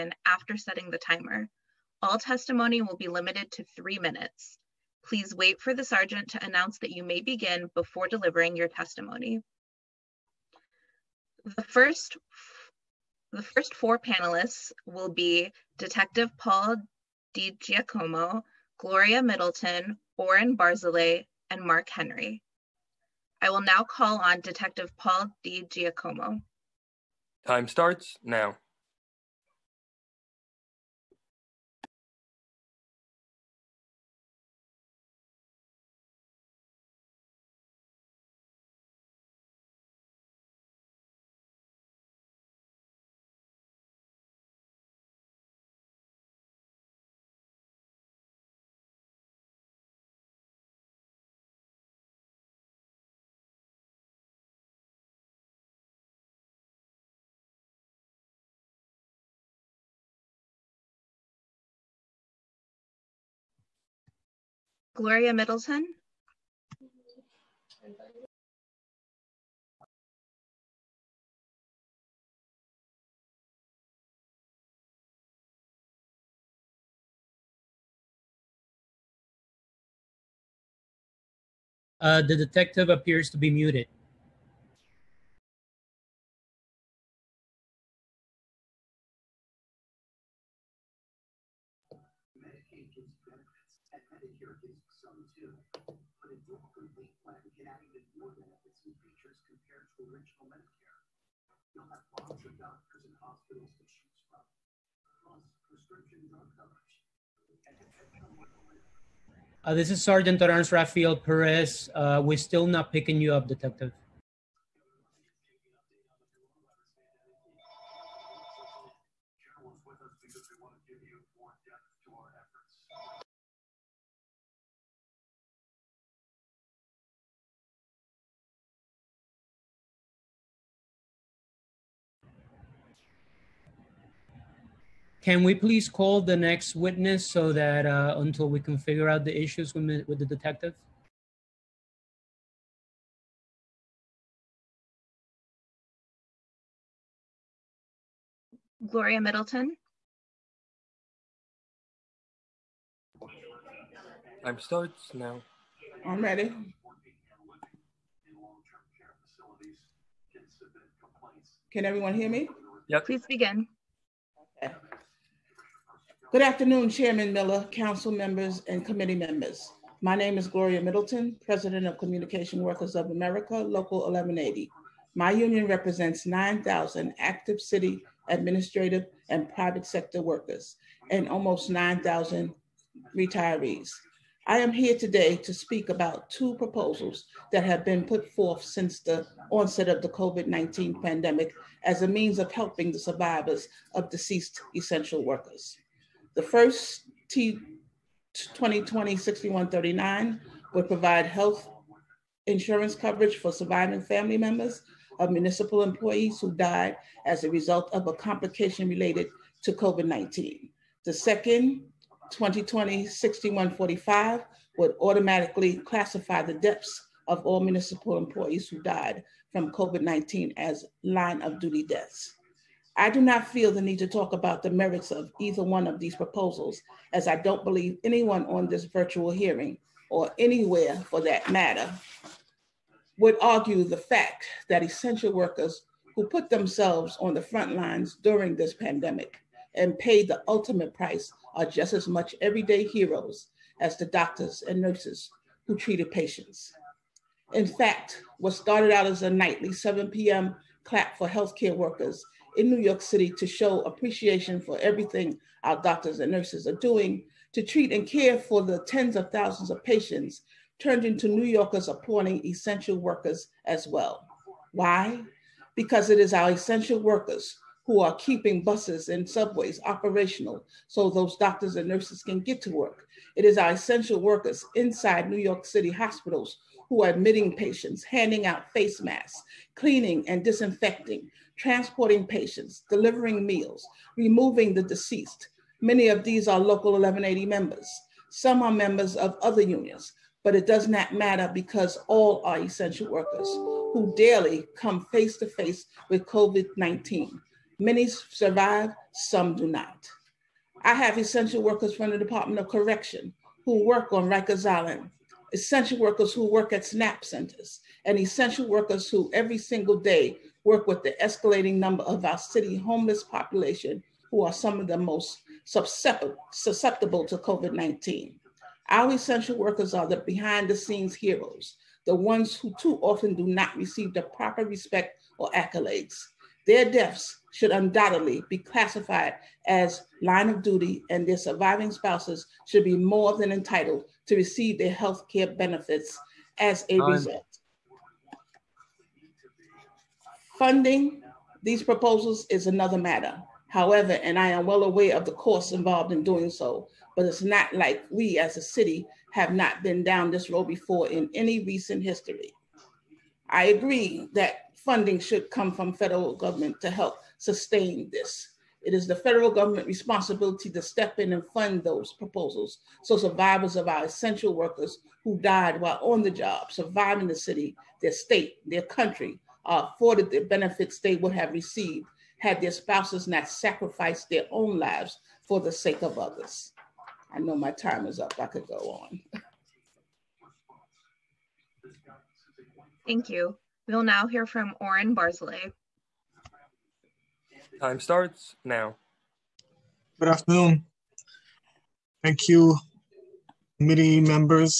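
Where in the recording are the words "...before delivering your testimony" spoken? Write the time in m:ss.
0:07.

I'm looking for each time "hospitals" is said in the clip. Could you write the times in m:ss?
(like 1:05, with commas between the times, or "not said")
1:43, 4:35.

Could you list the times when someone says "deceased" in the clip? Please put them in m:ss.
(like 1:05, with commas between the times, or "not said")
3:14, 4:44.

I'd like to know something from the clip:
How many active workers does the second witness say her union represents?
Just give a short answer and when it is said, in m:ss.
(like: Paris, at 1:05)
9,000, at 2:56.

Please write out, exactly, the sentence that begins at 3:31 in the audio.
The second 2020-6145 would automatically classify the deaths of all municipal employees who died from COVID-19 as line of duty deaths.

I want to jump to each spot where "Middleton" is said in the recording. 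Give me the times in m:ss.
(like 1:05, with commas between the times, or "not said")
0:19, 1:05, 2:29, 2:50.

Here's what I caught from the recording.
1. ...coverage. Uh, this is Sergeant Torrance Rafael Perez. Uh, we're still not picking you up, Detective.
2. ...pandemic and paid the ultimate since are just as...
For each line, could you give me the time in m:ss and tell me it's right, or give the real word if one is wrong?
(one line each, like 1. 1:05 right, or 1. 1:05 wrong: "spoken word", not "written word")
1. 1:46 right
2. 3:58 wrong: "price", not "since".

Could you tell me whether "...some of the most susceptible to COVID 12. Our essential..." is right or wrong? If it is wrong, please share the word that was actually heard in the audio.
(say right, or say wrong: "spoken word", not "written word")
wrong: "19", not "12".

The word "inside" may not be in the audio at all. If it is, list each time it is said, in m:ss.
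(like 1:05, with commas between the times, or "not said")
4:34.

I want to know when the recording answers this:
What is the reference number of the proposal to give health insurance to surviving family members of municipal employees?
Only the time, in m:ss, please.
3:17.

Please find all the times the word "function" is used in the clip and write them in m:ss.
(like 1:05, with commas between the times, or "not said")
not said.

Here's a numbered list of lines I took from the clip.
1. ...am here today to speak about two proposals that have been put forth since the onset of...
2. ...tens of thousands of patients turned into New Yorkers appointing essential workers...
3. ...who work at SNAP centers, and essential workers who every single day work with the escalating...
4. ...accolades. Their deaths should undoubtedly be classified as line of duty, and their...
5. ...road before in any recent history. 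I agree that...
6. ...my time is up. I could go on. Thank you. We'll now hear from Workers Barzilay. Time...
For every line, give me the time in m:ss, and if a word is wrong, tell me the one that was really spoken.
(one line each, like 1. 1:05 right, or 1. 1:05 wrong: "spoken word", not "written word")
1. 3:04 right
2. 4:18 right
3. 5:06 right
4. 5:25 right
5. 5:50 right
6. 6:17 wrong: "Oren", not "Workers".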